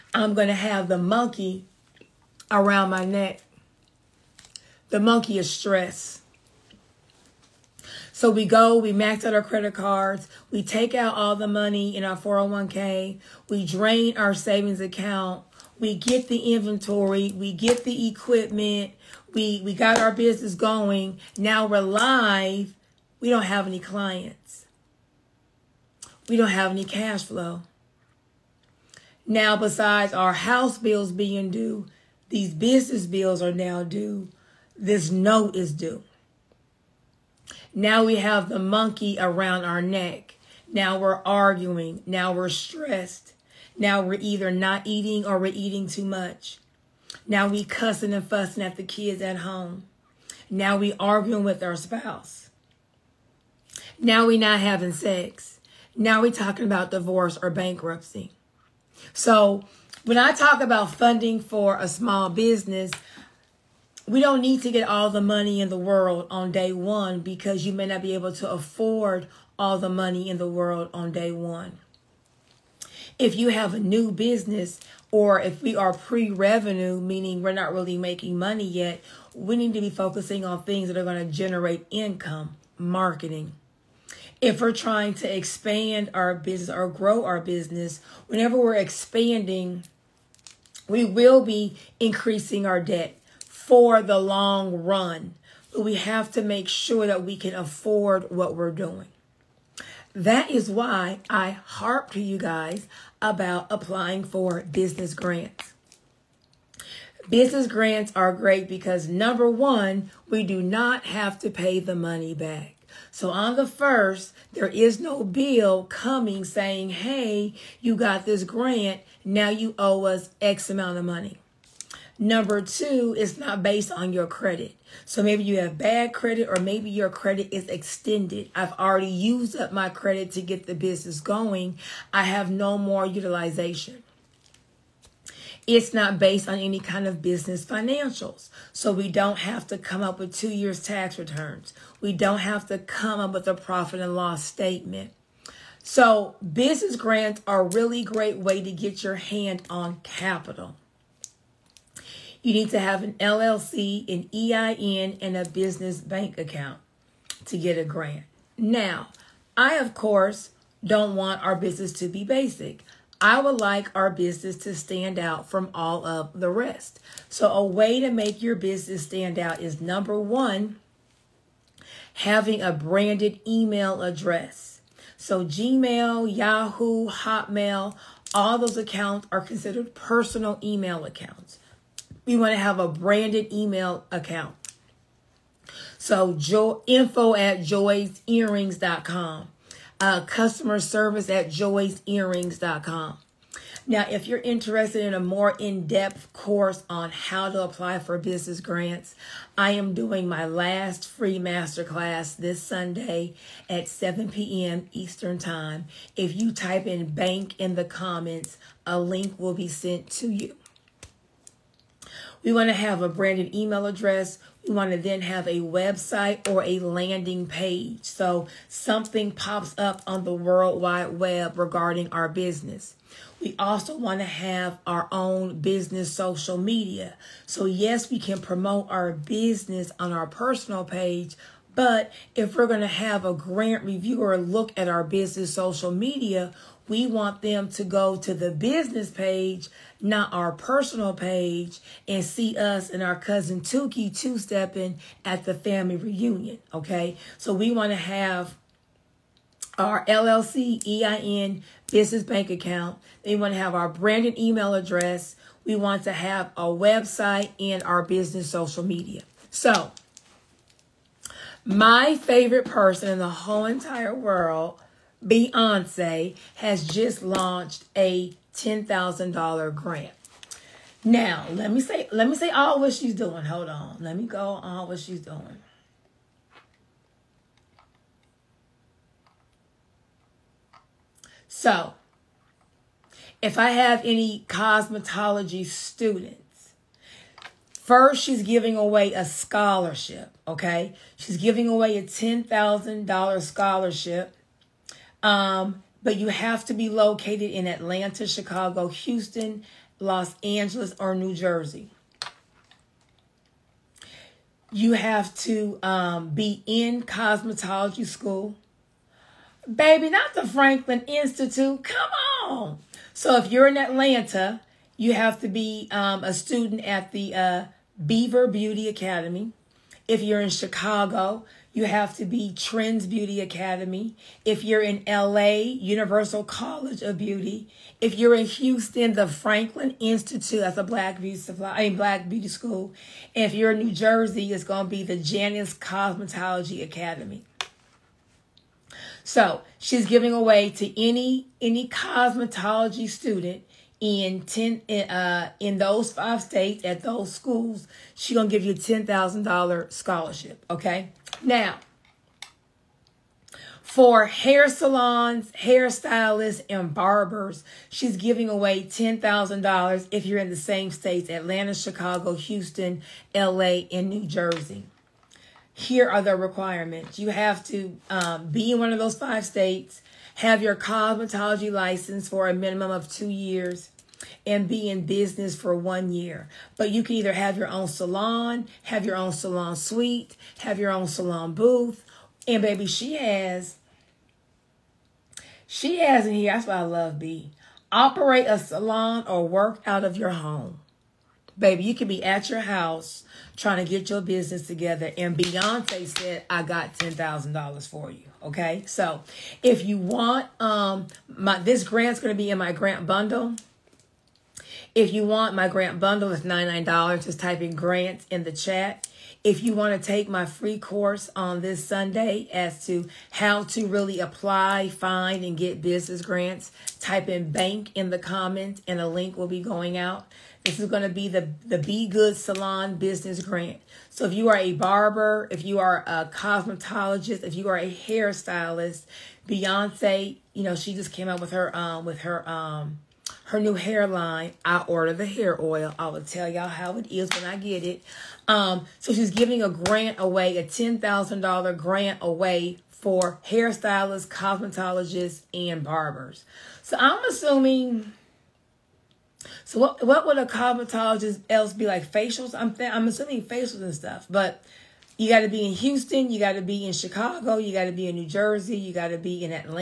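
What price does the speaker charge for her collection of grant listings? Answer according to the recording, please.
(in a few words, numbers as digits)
$99.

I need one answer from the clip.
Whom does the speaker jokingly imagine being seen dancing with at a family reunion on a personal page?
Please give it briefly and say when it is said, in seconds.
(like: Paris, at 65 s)
Cousin Tuki, at 243 s.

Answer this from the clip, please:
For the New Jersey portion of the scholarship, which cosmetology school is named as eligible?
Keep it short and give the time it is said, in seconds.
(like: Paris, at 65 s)
Janice Cosmetology Academy, at 335 s.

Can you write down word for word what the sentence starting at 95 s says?
But we have to make sure that we can afford what we're doing.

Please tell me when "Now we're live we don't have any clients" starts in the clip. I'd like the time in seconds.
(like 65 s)
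21 s.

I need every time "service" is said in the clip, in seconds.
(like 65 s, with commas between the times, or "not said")
190 s.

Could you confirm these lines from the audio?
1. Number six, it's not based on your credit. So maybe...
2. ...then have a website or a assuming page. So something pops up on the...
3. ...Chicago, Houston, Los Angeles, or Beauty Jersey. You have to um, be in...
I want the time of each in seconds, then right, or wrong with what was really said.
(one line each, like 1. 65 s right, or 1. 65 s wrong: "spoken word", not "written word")
1. 122 s wrong: "two", not "six"
2. 214 s wrong: "landing", not "assuming"
3. 298 s wrong: "New", not "Beauty".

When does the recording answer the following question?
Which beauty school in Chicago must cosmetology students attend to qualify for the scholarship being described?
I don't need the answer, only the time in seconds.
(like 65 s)
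322 s.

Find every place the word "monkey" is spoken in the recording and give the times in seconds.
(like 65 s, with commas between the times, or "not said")
0 s, 4 s, 38 s.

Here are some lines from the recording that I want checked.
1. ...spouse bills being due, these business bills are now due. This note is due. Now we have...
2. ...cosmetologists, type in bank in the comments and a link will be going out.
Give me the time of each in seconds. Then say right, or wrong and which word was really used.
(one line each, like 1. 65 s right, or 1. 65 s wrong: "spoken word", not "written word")
1. 30 s wrong: "house", not "spouse"
2. 416 s wrong: "grants", not "cosmetologists".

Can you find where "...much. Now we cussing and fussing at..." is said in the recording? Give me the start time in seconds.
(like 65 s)
46 s.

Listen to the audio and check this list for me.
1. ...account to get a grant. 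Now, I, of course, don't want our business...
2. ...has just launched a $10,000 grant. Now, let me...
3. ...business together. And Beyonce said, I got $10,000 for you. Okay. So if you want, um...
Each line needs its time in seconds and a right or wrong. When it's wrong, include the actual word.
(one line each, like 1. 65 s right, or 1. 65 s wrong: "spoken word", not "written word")
1. 156 s right
2. 266 s right
3. 394 s right.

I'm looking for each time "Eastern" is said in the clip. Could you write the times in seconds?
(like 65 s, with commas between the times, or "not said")
204 s.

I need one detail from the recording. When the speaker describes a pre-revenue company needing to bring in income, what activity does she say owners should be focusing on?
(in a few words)
Marketing.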